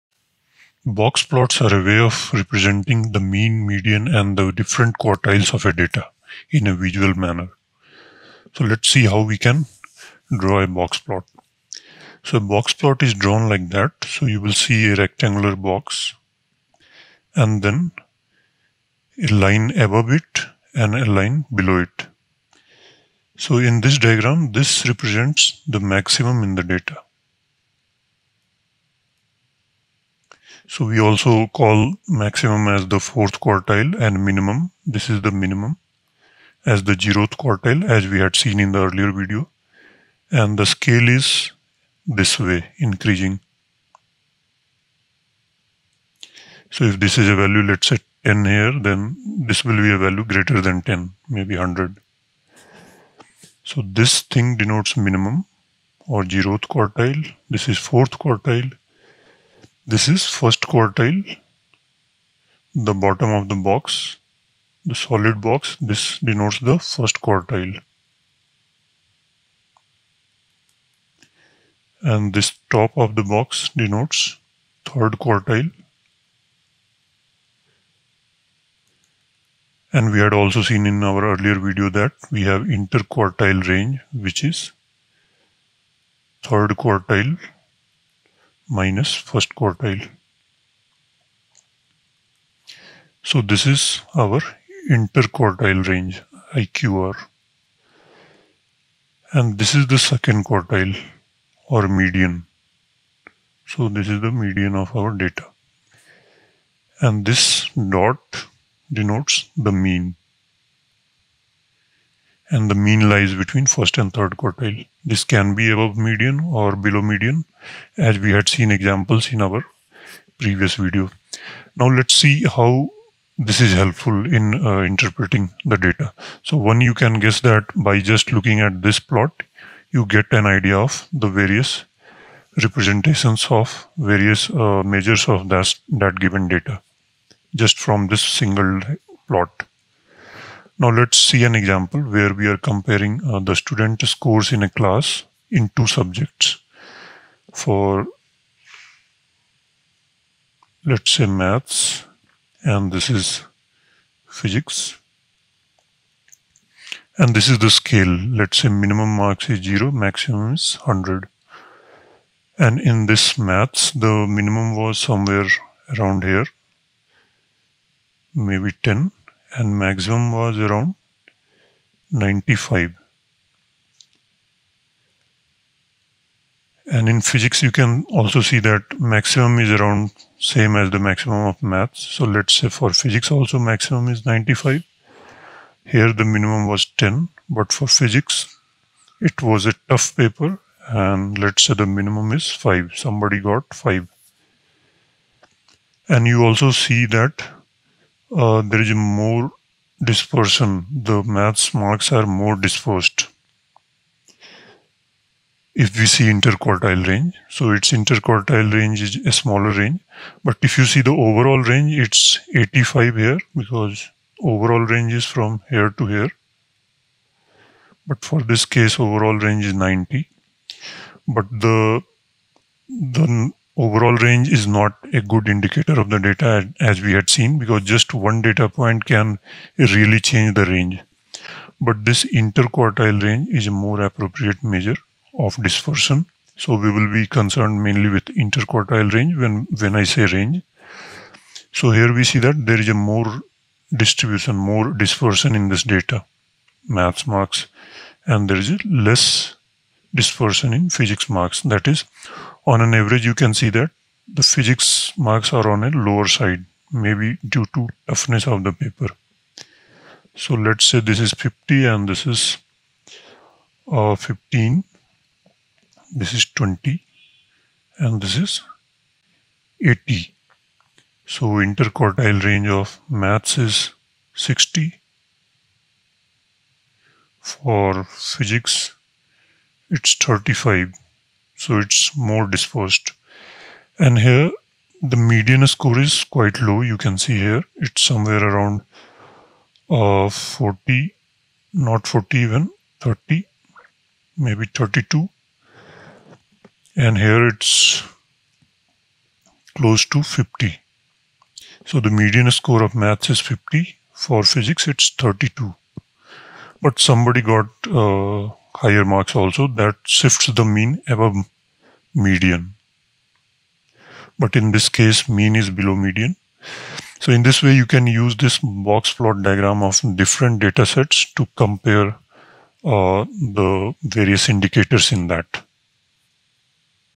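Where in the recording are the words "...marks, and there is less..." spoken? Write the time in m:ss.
4:07.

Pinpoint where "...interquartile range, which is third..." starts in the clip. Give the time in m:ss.
1:22.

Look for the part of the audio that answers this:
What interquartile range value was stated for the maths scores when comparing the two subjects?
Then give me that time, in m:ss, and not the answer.
4:34.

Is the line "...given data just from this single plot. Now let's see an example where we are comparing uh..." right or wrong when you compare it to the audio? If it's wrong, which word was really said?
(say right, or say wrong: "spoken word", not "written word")
right.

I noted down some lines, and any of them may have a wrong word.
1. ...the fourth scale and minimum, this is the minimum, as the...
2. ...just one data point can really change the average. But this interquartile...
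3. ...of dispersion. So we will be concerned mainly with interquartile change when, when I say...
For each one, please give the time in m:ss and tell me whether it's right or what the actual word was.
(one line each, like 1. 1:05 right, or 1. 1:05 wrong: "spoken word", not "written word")
1. 0:32 wrong: "quartile", not "scale"
2. 3:47 wrong: "range", not "average"
3. 3:55 wrong: "range", not "change".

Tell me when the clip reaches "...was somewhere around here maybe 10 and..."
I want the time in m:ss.
2:44.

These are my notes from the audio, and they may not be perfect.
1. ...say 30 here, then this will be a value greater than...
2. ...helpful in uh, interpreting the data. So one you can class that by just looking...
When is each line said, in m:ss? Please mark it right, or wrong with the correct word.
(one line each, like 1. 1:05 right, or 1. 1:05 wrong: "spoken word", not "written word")
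1. 0:47 wrong: "10", not "30"
2. 2:03 wrong: "guess", not "class".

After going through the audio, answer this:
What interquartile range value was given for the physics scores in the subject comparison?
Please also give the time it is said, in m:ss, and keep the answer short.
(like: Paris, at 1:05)
35, at 4:40.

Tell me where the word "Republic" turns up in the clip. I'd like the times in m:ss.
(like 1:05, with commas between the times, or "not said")
not said.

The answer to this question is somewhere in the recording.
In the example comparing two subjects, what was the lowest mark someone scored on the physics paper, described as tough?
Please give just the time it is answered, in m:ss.
3:12.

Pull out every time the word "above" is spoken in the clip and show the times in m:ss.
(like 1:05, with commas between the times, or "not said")
0:19, 1:55, 5:11.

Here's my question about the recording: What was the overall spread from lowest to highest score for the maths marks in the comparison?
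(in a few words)
85.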